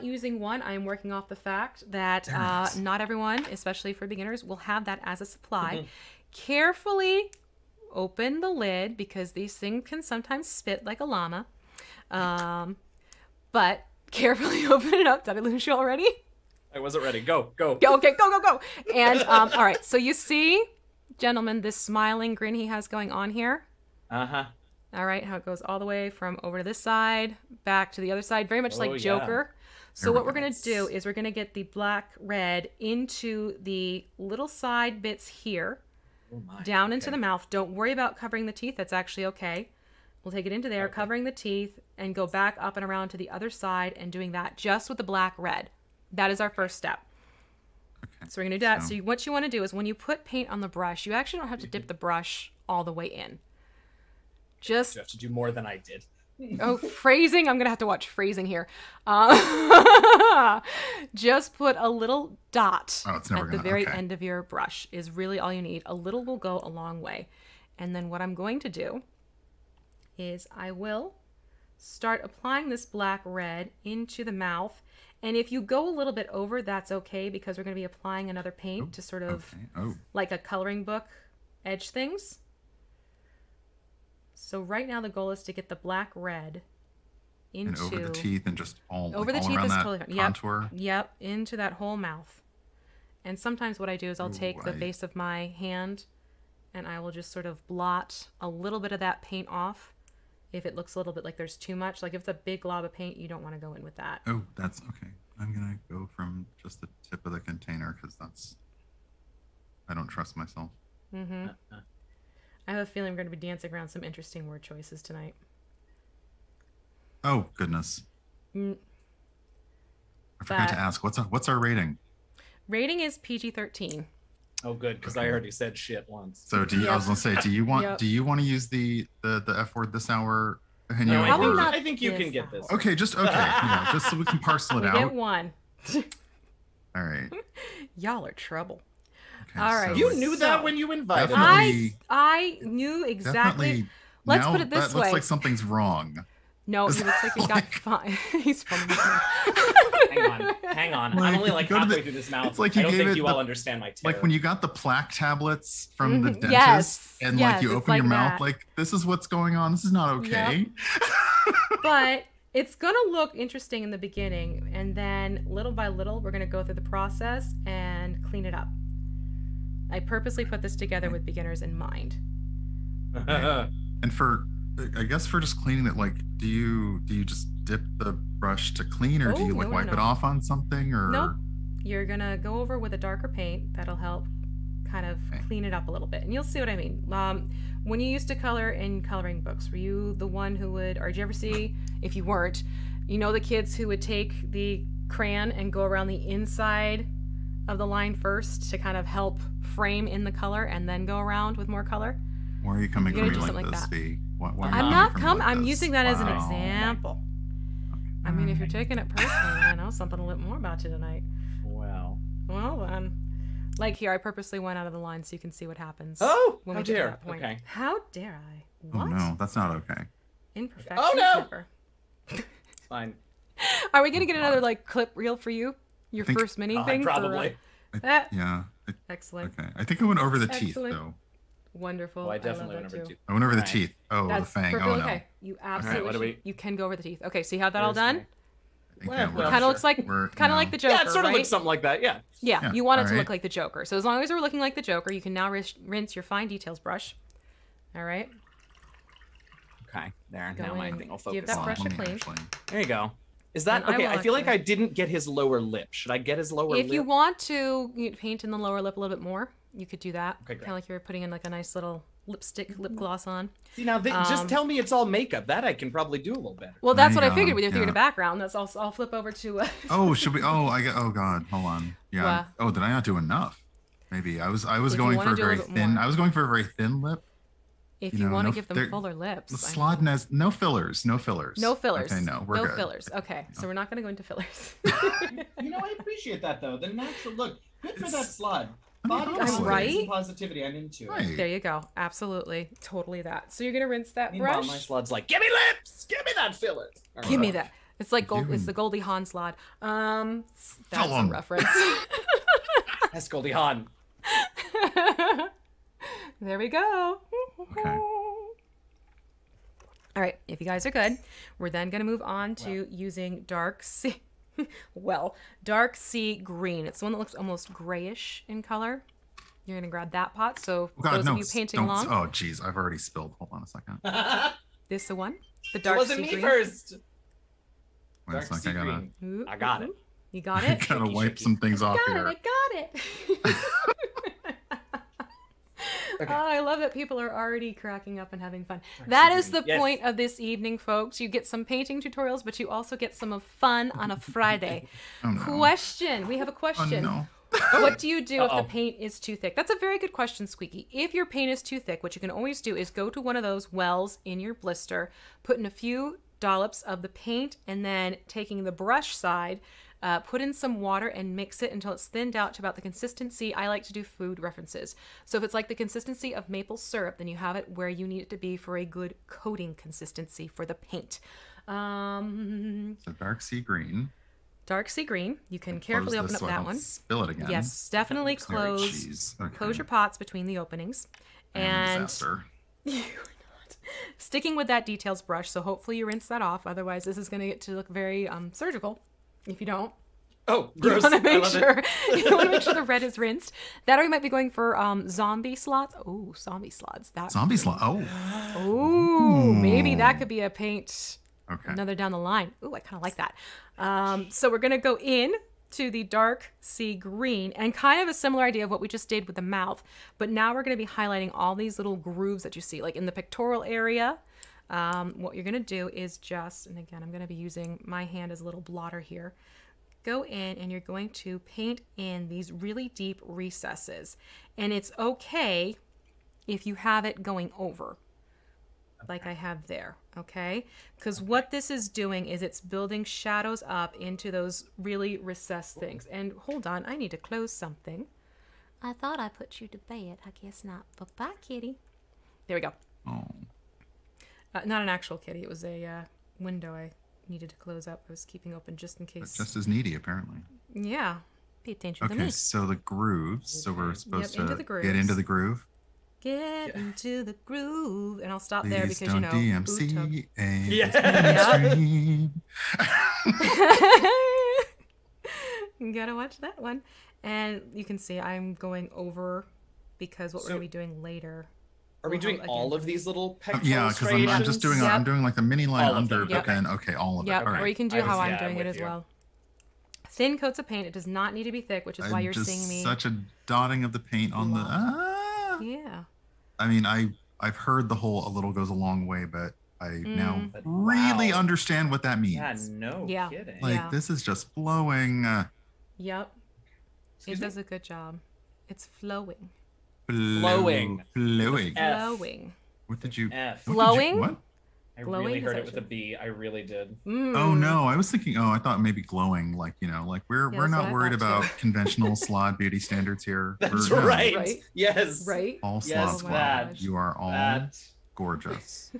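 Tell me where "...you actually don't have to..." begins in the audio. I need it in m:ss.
0:51.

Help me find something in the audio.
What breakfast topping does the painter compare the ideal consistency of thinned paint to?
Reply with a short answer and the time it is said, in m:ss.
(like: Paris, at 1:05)
maple syrup, at 6:06.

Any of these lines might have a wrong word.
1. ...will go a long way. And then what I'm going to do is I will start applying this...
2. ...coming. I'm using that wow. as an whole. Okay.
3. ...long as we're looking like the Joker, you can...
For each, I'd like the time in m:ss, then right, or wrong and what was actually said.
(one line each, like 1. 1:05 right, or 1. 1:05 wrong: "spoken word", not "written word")
1. 1:06 right
2. 3:25 wrong: "example", not "whole"
3. 4:04 right.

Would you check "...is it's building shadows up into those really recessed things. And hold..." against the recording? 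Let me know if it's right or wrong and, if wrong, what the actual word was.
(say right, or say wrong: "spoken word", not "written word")
right.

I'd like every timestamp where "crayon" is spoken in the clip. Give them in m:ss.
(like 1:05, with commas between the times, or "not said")
3:15.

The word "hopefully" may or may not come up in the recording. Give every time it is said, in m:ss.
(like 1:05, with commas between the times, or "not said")
6:25.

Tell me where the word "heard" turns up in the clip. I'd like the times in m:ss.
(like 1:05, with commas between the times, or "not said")
8:07, 8:25.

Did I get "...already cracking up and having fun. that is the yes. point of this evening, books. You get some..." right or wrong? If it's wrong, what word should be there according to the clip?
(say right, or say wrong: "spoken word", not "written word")
wrong: "folks", not "books".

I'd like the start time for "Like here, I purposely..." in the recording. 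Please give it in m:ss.
3:33.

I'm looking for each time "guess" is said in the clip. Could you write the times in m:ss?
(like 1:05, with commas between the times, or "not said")
2:55, 7:20.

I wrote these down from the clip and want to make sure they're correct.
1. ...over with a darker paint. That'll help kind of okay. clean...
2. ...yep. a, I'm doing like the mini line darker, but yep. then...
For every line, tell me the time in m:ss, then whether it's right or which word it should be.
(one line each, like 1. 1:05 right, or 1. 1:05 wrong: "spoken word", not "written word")
1. 3:02 right
2. 7:54 wrong: "under", not "darker".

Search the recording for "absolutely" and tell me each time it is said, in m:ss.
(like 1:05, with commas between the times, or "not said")
3:55, 4:51.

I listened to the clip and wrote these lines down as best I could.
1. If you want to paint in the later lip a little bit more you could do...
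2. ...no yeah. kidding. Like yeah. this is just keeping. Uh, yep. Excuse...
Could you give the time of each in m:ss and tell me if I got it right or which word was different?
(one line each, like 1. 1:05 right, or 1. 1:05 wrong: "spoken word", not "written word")
1. 4:16 wrong: "lower", not "later"
2. 8:12 wrong: "flowing", not "keeping".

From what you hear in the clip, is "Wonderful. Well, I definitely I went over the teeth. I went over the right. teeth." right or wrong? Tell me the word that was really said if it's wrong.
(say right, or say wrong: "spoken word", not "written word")
right.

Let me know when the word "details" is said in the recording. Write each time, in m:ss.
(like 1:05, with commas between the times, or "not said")
4:06, 6:24.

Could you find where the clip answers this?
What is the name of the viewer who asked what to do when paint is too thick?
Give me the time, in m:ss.
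5:50.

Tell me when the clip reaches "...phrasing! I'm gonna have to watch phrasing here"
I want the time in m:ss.
0:56.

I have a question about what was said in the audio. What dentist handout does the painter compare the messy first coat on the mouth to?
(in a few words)
plaque tablets.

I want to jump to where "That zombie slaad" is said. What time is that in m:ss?
6:37.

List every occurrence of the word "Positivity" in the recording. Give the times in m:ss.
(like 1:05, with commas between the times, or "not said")
4:50.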